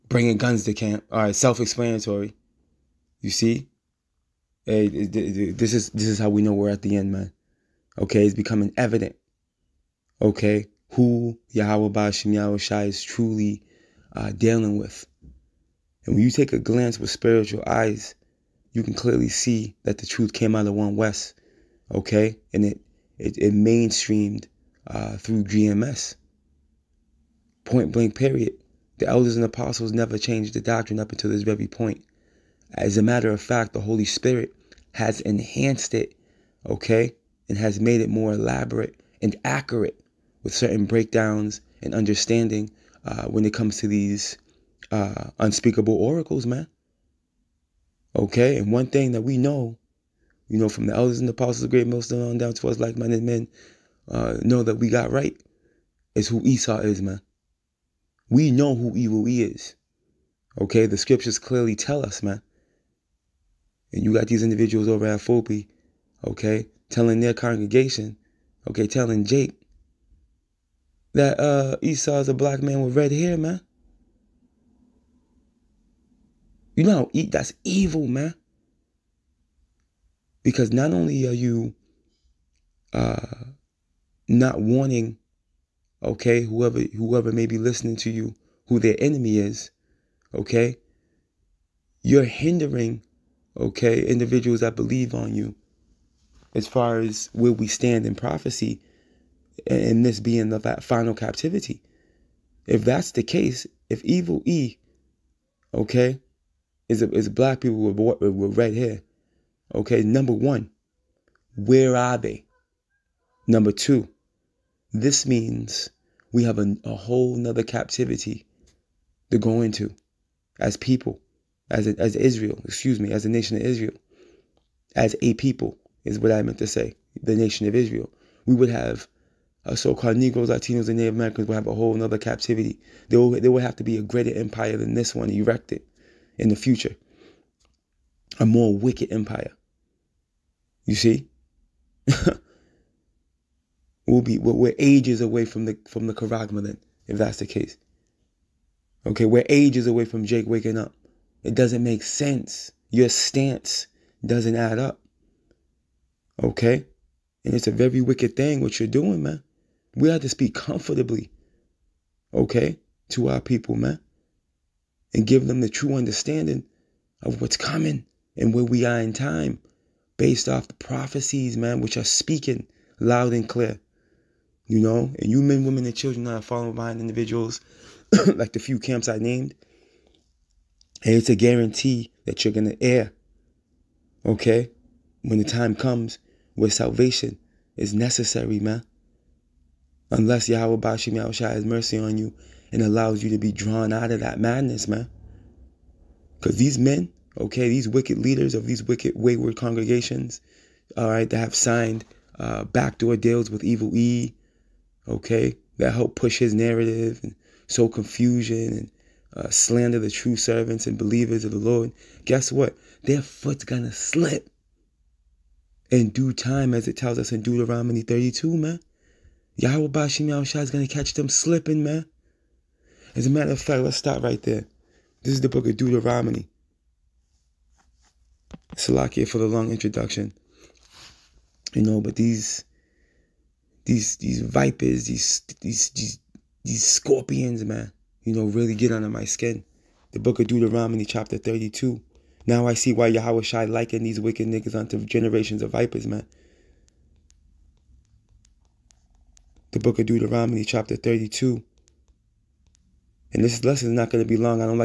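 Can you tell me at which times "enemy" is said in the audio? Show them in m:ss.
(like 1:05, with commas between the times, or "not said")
1:28.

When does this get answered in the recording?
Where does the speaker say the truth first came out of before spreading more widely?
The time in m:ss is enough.
0:20.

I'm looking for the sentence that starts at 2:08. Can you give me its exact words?
We would have uh, so-called Negroes, Latinos, and Native Americans will have a whole another captivity.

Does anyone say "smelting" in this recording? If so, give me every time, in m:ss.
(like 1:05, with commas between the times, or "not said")
not said.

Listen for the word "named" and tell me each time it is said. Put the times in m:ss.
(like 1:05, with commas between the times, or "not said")
2:59.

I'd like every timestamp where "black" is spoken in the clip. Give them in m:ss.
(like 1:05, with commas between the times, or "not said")
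1:12, 1:47.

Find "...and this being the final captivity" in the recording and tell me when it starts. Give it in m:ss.
1:39.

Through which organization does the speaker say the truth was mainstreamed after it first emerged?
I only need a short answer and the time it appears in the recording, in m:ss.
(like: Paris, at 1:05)
GMS, at 0:25.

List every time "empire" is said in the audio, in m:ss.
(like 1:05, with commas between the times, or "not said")
2:14, 2:19.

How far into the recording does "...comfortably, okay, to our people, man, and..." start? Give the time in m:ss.
2:40.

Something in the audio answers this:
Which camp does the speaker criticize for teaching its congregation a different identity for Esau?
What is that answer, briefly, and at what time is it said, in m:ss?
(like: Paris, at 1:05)
Fulby, at 1:05.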